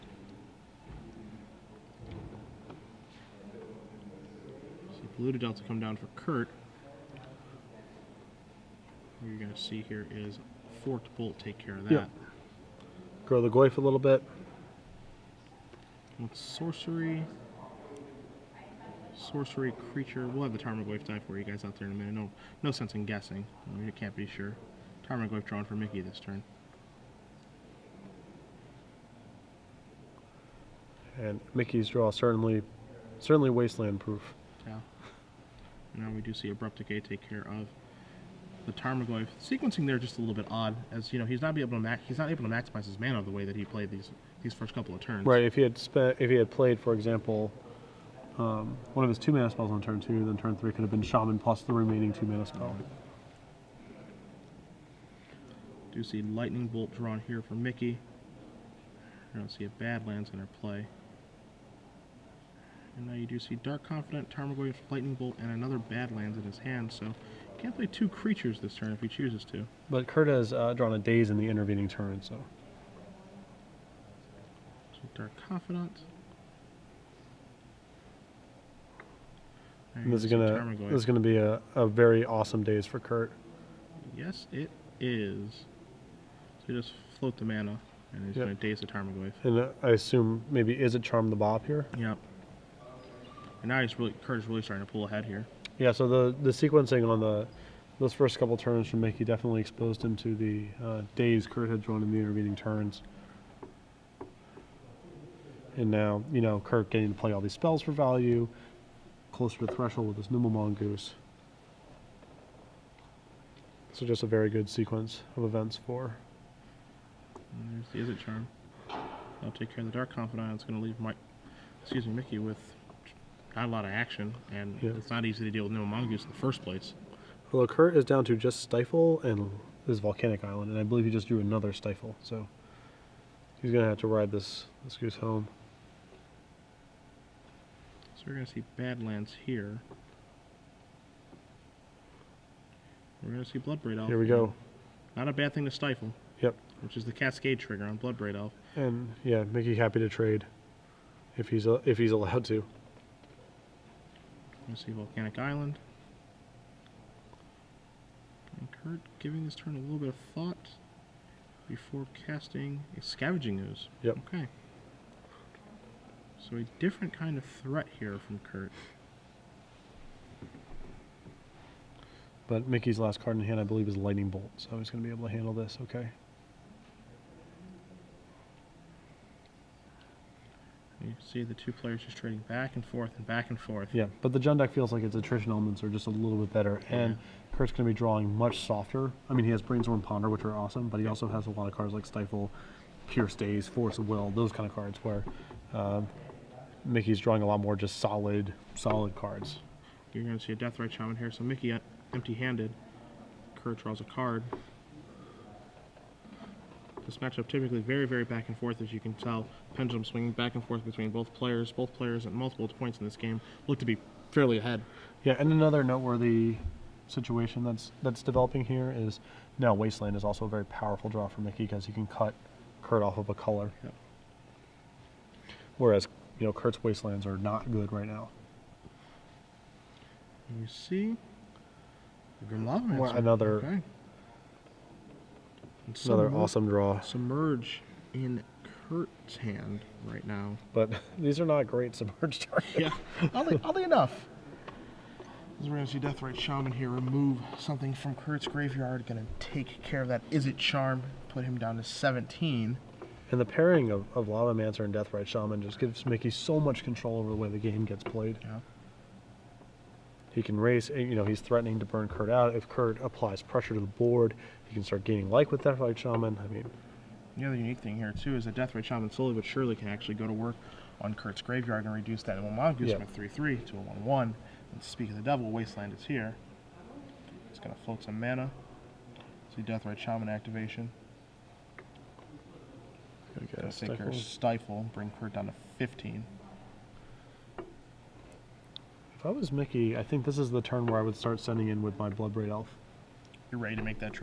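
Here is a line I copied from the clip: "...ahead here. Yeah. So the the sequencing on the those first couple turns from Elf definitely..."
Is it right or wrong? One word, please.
wrong.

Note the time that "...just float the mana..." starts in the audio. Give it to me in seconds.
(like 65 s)
86 s.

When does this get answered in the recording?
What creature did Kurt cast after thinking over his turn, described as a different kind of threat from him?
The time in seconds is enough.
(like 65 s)
163 s.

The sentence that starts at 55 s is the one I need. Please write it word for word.
Do see Lightning Bolt drawn here for Miki.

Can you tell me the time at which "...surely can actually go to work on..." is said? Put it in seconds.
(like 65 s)
269 s.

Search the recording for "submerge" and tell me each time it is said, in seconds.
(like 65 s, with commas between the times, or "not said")
236 s, 241 s.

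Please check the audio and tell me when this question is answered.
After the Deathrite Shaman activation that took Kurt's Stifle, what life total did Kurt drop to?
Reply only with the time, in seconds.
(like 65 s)
285 s.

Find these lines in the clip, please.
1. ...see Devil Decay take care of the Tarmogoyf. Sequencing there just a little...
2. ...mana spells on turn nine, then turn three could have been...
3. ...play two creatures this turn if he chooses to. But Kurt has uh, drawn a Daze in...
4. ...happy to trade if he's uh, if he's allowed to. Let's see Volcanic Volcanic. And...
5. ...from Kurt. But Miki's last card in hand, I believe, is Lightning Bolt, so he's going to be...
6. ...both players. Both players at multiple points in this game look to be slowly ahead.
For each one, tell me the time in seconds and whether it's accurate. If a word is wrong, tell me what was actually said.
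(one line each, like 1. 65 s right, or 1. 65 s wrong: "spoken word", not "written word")
1. 36 s wrong: "Abrupt", not "Devil"
2. 49 s wrong: "two", not "nine"
3. 67 s right
4. 149 s wrong: "Island", not "Volcanic"
5. 168 s right
6. 211 s wrong: "fairly", not "slowly".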